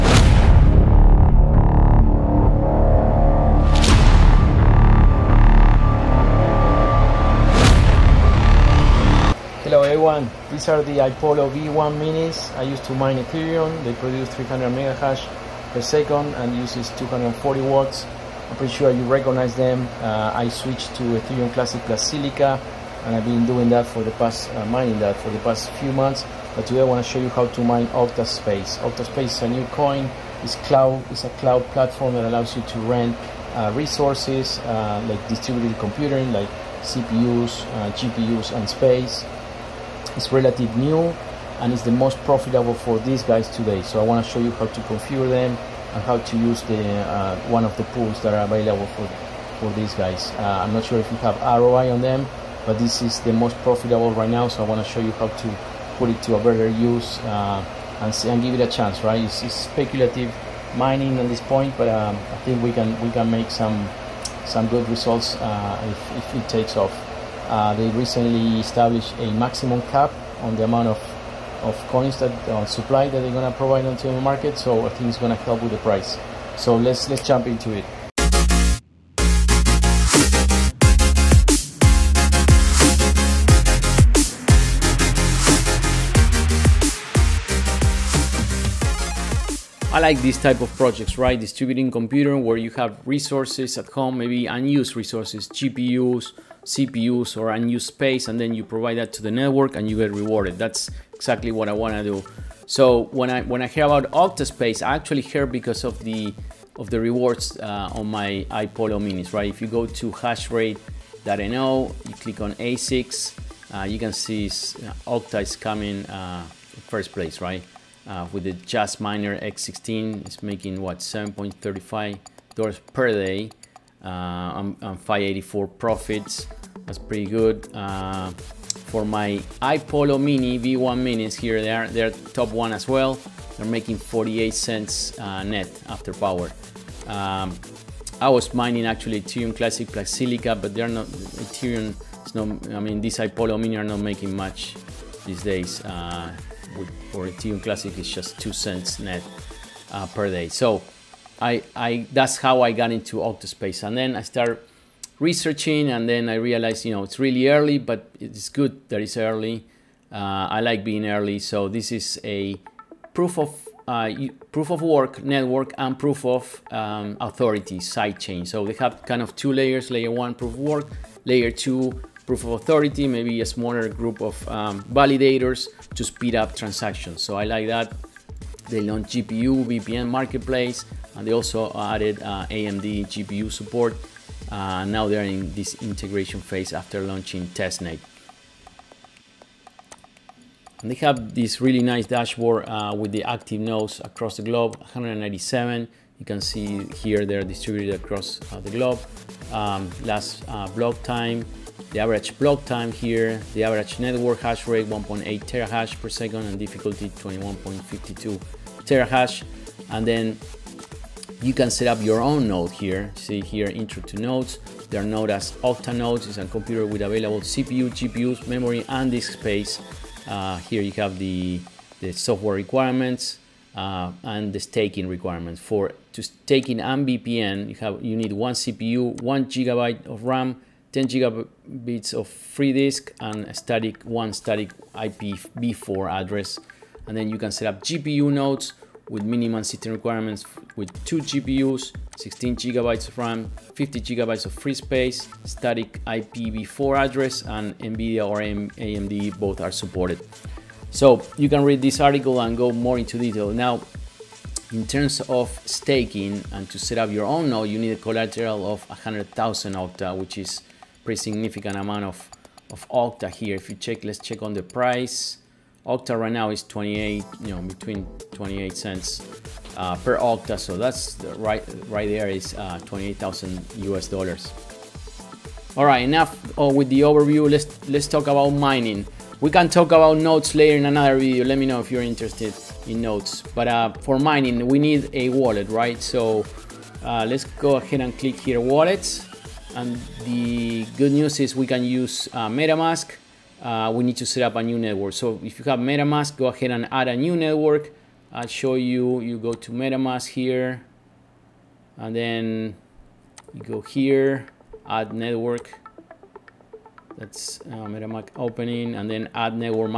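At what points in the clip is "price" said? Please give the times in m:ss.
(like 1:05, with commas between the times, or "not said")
1:15, 4:24.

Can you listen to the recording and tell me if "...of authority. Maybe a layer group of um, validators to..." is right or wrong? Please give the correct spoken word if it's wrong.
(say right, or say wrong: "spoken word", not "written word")
wrong: "smaller", not "layer".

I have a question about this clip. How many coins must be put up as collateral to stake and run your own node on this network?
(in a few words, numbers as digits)
100,000 Octa.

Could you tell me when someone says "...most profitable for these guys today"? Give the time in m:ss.
0:41.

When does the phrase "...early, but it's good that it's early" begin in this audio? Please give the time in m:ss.
2:37.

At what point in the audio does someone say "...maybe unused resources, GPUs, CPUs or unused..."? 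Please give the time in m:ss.
1:34.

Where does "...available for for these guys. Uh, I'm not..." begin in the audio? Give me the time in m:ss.
0:48.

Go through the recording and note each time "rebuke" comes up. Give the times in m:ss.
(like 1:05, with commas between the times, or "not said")
not said.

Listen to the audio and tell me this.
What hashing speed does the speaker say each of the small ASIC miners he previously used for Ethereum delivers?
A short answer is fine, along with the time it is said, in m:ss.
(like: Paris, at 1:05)
300 megahash per second, at 0:14.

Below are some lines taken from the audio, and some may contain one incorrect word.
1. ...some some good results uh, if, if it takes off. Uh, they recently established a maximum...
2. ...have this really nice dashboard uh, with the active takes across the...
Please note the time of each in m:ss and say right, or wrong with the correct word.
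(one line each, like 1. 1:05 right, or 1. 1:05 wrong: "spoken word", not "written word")
1. 1:03 right
2. 3:10 wrong: "nodes", not "takes".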